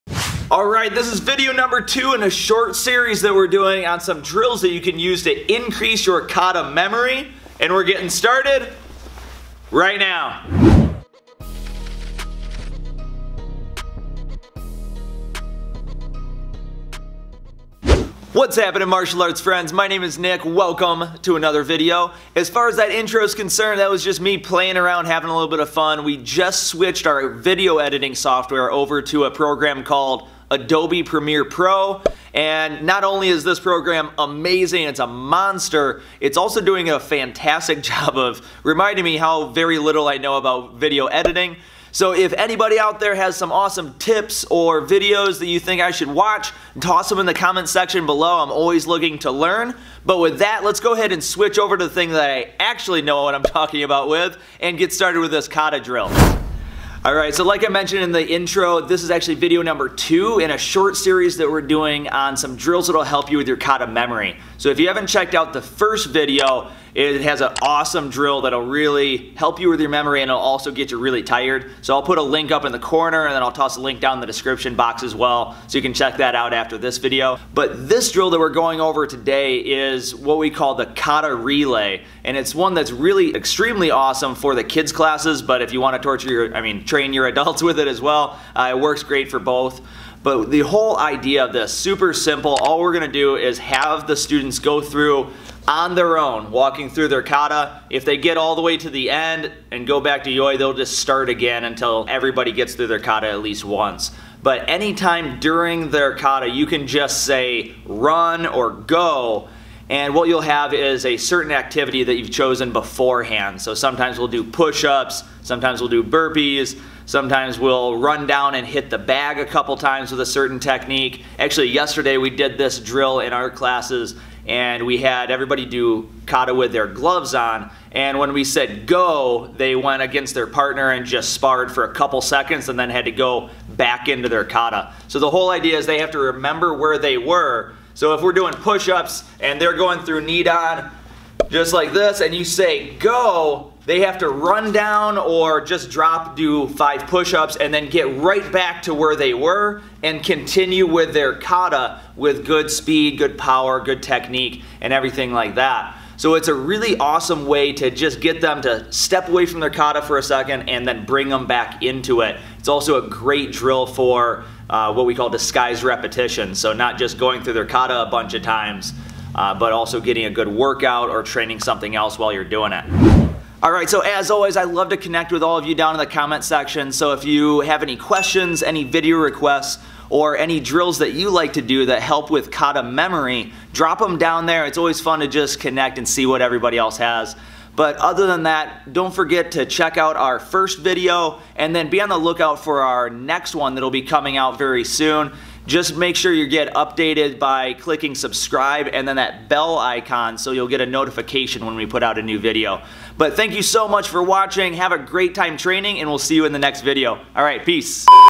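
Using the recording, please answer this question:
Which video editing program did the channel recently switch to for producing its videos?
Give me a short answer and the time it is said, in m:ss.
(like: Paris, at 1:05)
Adobe Premiere Pro, at 0:30.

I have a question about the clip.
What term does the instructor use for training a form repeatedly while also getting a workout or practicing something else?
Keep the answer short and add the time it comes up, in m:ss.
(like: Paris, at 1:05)
Disguised repetition, at 2:45.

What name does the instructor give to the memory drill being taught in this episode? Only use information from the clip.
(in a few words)
Kata relay.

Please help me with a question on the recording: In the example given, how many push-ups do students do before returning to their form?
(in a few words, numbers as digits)
5.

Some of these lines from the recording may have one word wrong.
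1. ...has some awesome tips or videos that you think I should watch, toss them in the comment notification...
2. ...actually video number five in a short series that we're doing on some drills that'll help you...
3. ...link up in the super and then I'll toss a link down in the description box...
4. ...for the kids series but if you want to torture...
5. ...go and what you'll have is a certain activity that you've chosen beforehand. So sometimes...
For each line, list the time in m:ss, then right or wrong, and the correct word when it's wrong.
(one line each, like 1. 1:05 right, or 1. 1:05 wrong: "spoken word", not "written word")
1. 0:43 wrong: "section", not "notification"
2. 0:59 wrong: "two", not "five"
3. 1:12 wrong: "corner", not "super"
4. 1:24 wrong: "classes", not "series"
5. 1:48 right.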